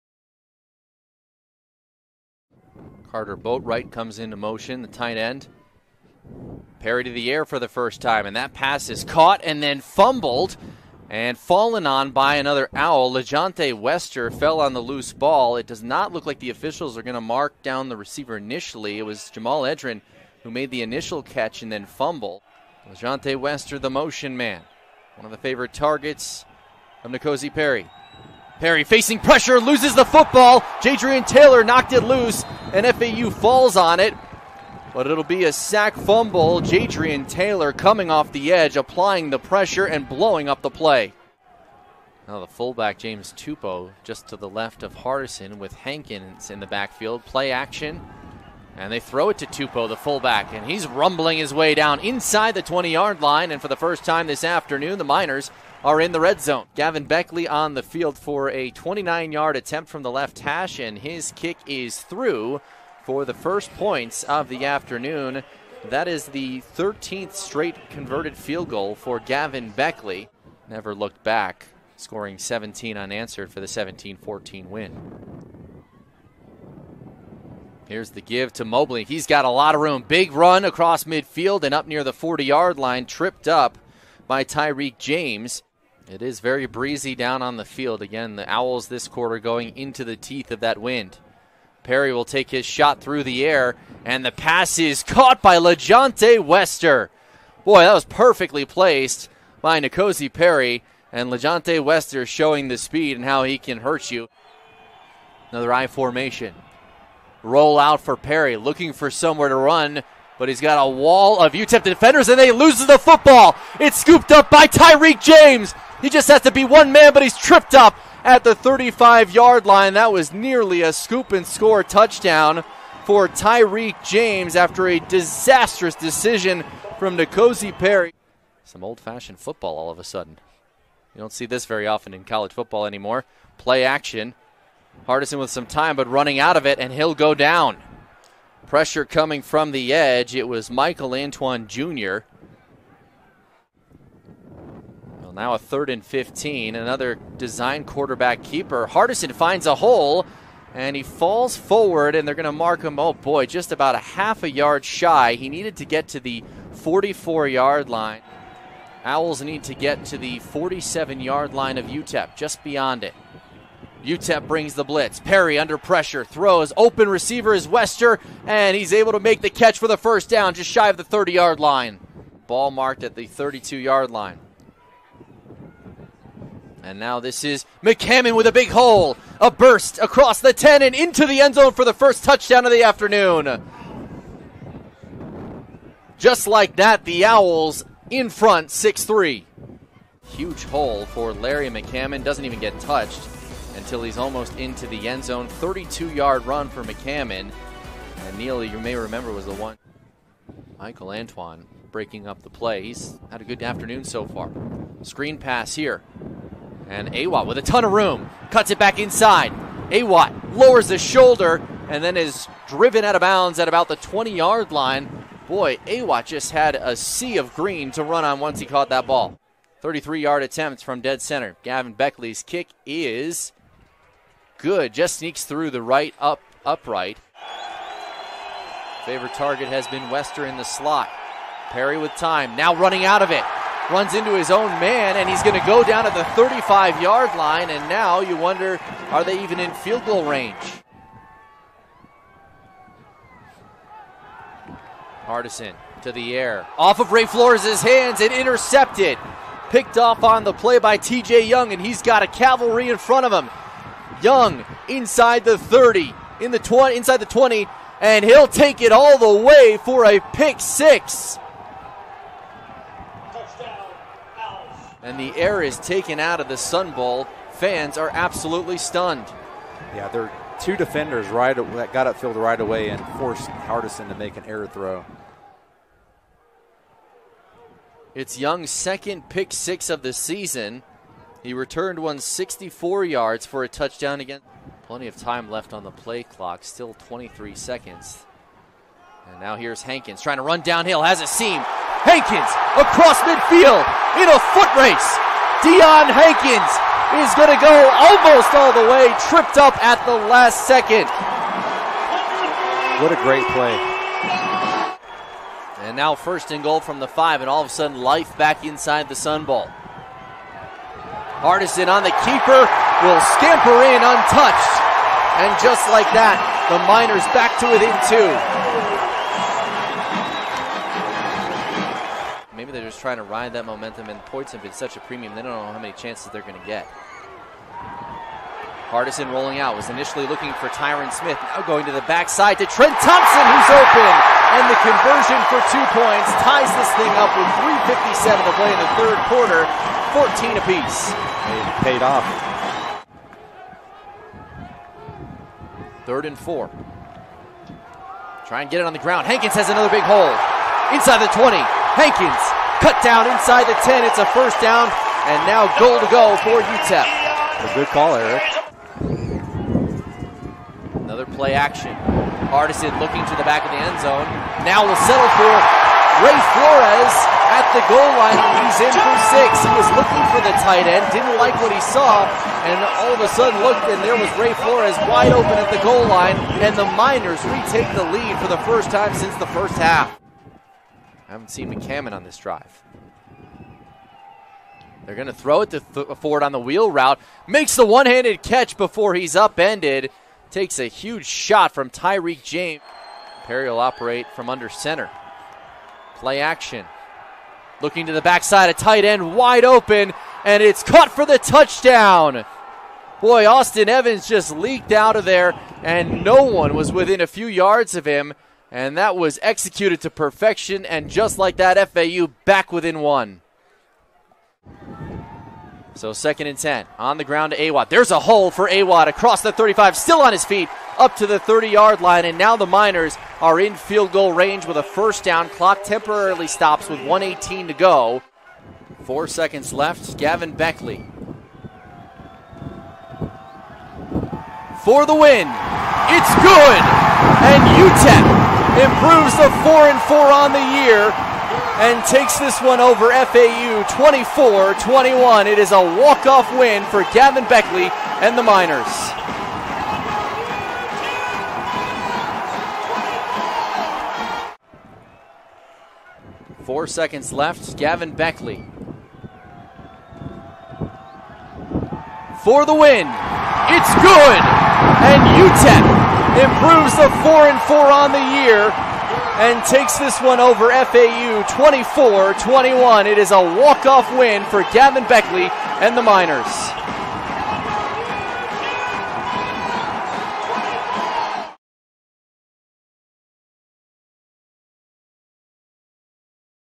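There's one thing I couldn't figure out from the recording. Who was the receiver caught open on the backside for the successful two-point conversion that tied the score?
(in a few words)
Trent Thompson.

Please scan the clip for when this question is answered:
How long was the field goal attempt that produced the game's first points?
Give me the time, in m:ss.
0:58.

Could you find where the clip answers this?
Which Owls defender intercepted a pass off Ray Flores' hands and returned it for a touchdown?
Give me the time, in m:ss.
4:10.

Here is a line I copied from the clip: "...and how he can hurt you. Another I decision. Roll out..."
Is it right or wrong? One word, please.
wrong.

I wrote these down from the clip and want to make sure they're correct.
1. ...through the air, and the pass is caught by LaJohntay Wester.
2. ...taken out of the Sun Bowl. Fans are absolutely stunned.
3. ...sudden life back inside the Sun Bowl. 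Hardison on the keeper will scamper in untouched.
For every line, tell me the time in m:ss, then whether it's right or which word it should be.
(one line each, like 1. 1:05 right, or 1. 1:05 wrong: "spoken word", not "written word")
1. 1:33 right
2. 4:25 right
3. 5:07 right.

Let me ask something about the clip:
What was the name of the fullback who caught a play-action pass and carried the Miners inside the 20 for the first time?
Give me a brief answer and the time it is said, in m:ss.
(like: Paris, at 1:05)
James Tupo, at 0:42.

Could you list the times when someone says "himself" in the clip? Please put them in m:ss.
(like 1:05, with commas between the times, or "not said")
not said.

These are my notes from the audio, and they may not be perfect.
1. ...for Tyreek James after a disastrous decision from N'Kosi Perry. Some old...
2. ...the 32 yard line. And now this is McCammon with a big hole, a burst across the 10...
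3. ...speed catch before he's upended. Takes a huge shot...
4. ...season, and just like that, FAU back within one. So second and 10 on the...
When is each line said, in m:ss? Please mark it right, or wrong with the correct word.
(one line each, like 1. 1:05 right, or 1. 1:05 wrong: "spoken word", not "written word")
1. 2:03 right
2. 2:53 right
3. 6:28 wrong: "handed", not "speed"
4. 6:50 wrong: "perfection", not "season".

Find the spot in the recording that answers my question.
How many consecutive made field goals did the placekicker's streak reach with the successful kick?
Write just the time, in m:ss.
1:06.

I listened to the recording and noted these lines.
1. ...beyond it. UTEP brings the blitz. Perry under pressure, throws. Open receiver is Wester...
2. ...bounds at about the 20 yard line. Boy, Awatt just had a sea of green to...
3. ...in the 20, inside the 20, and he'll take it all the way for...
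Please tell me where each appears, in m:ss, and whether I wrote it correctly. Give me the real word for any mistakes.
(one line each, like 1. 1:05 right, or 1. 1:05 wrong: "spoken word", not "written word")
1. 2:42 right
2. 3:33 right
3. 4:16 right.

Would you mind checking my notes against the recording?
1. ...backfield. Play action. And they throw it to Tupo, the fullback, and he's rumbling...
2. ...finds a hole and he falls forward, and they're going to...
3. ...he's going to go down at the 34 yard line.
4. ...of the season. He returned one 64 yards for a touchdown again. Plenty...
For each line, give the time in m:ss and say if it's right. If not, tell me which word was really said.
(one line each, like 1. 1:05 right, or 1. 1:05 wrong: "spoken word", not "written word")
1. 0:46 right
2. 2:29 right
3. 3:55 wrong: "35", not "34"
4. 4:39 right.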